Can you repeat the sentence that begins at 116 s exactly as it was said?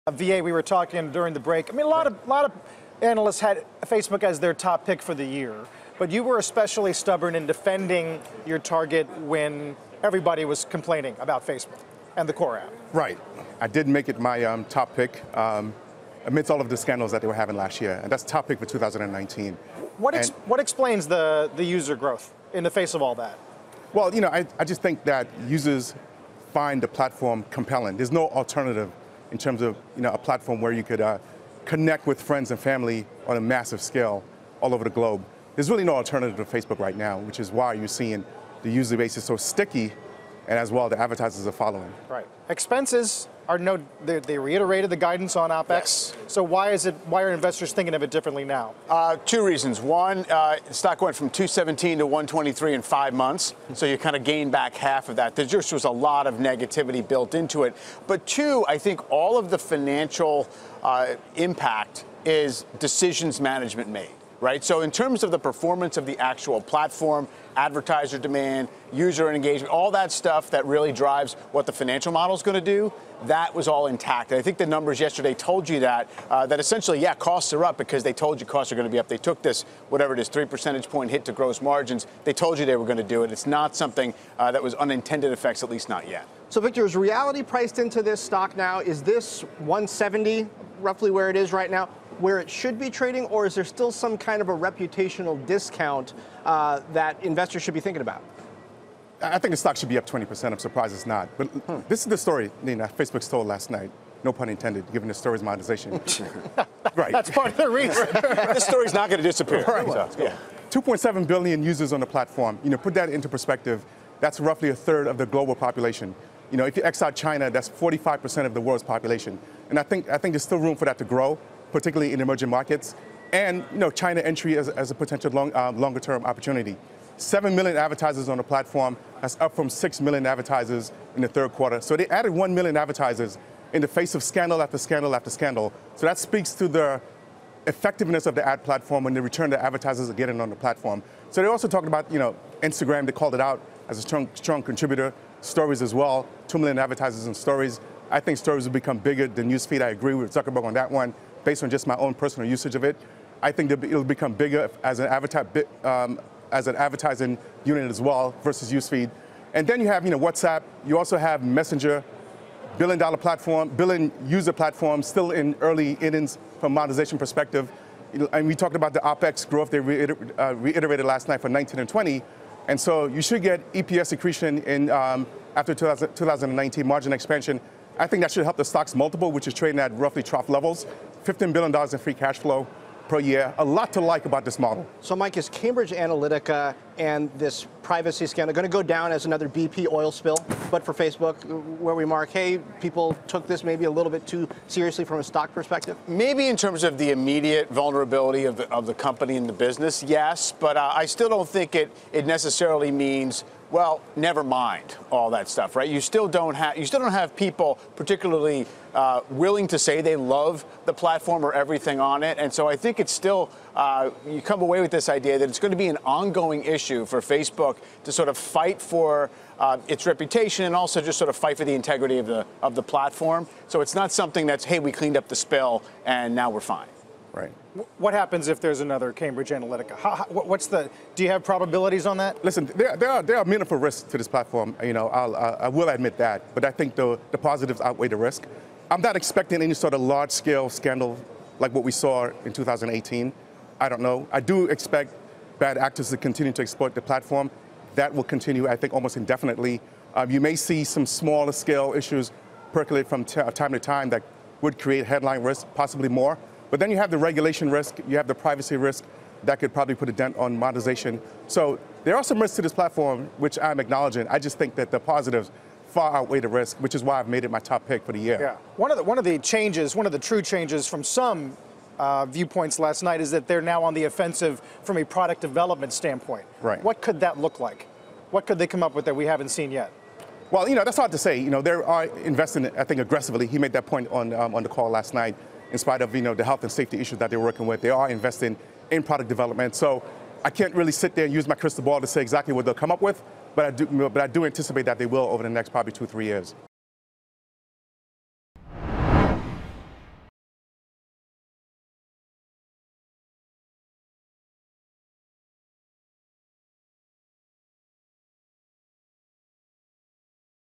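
You know, if you X out China, that's 45% of the world's population.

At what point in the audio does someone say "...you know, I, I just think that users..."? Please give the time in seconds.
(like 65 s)
24 s.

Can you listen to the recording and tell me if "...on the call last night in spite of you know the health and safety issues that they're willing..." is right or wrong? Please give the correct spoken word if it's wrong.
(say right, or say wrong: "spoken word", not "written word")
wrong: "working", not "willing".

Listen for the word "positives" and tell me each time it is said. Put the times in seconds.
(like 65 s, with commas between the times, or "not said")
237 s, 264 s.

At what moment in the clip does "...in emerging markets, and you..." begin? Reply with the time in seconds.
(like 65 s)
122 s.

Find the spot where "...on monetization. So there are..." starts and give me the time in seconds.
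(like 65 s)
260 s.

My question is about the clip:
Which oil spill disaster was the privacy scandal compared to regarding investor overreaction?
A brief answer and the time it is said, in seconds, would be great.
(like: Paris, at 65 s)
BP oil spill, at 189 s.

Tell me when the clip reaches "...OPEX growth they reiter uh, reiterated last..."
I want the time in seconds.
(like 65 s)
168 s.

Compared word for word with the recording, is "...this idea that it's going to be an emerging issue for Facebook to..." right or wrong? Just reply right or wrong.
wrong.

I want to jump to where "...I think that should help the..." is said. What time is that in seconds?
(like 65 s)
178 s.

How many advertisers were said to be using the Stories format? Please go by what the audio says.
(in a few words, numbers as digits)
2 million.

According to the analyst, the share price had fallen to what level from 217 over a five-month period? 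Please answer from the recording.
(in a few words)
123.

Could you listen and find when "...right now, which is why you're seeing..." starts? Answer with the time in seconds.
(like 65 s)
36 s.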